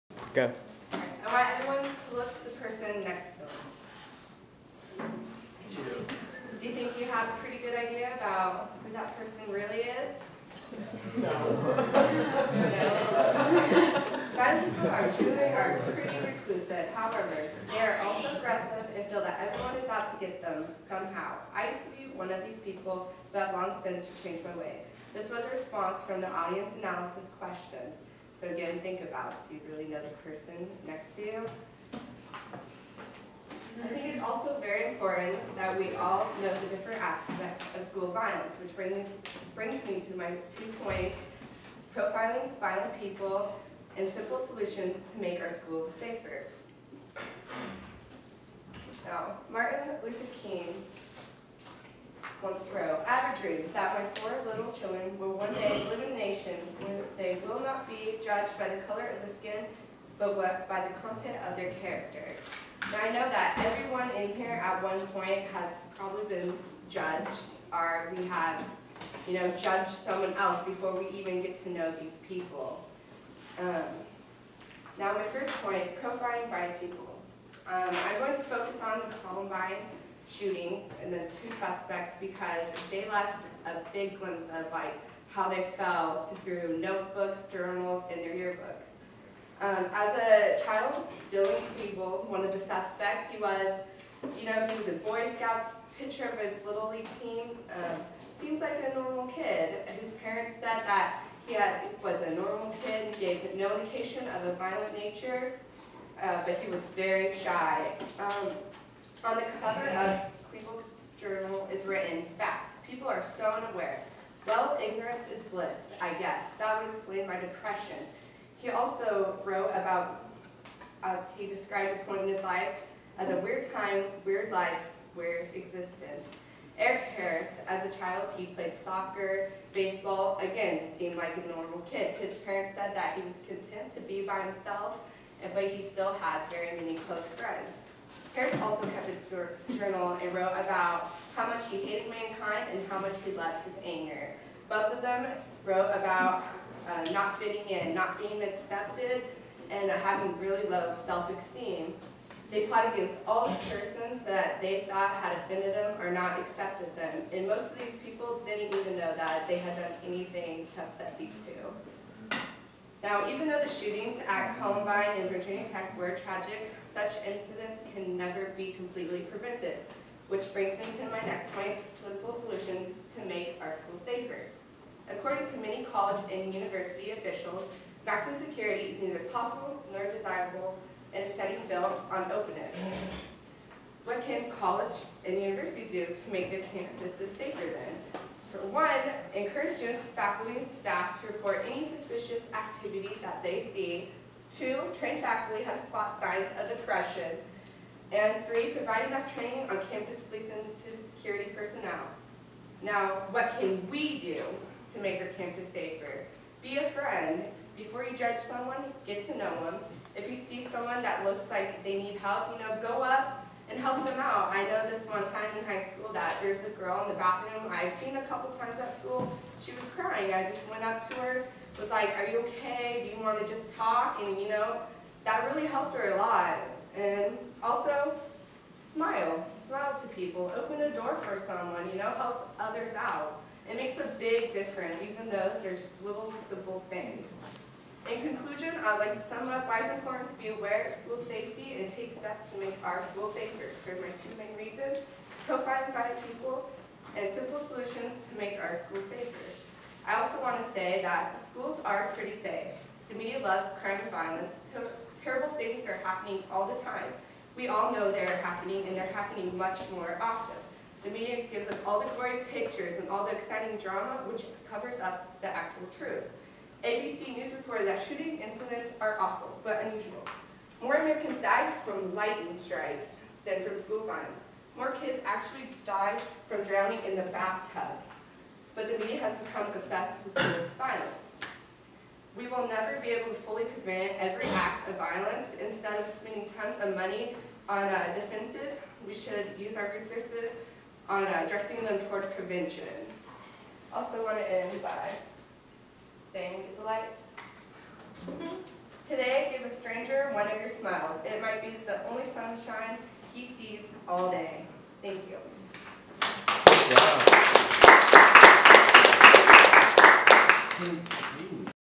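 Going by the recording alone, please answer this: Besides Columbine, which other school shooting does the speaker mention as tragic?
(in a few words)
Virginia Tech.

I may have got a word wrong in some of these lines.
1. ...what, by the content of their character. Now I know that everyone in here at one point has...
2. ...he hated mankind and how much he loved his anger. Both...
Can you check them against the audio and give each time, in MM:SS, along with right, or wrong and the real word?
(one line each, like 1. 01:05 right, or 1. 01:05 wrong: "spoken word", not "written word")
1. 01:00 right
2. 02:21 right.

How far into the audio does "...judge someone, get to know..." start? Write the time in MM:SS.
03:28.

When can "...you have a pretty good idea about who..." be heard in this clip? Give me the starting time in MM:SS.
00:06.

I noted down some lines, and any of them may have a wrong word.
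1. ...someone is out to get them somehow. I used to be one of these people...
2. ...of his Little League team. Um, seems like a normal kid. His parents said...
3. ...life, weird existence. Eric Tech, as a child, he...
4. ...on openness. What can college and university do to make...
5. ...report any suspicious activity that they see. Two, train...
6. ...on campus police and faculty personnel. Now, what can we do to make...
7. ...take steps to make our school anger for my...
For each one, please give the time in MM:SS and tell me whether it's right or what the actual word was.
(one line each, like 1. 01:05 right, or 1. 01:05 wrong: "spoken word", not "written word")
1. 00:19 wrong: "everyone", not "someone"
2. 01:36 right
3. 02:04 wrong: "Harris", not "Tech"
4. 03:02 right
5. 03:11 right
6. 03:19 wrong: "security", not "faculty"
7. 04:01 wrong: "safer", not "anger".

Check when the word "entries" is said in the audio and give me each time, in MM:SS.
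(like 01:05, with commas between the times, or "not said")
not said.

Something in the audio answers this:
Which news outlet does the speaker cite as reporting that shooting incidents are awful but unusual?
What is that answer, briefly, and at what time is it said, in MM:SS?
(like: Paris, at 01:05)
ABC News, at 04:26.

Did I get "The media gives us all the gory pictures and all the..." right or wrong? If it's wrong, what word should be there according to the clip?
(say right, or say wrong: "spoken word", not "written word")
right.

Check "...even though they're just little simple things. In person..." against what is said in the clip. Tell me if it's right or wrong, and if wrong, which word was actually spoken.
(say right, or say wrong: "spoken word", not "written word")
wrong: "conclusion", not "person".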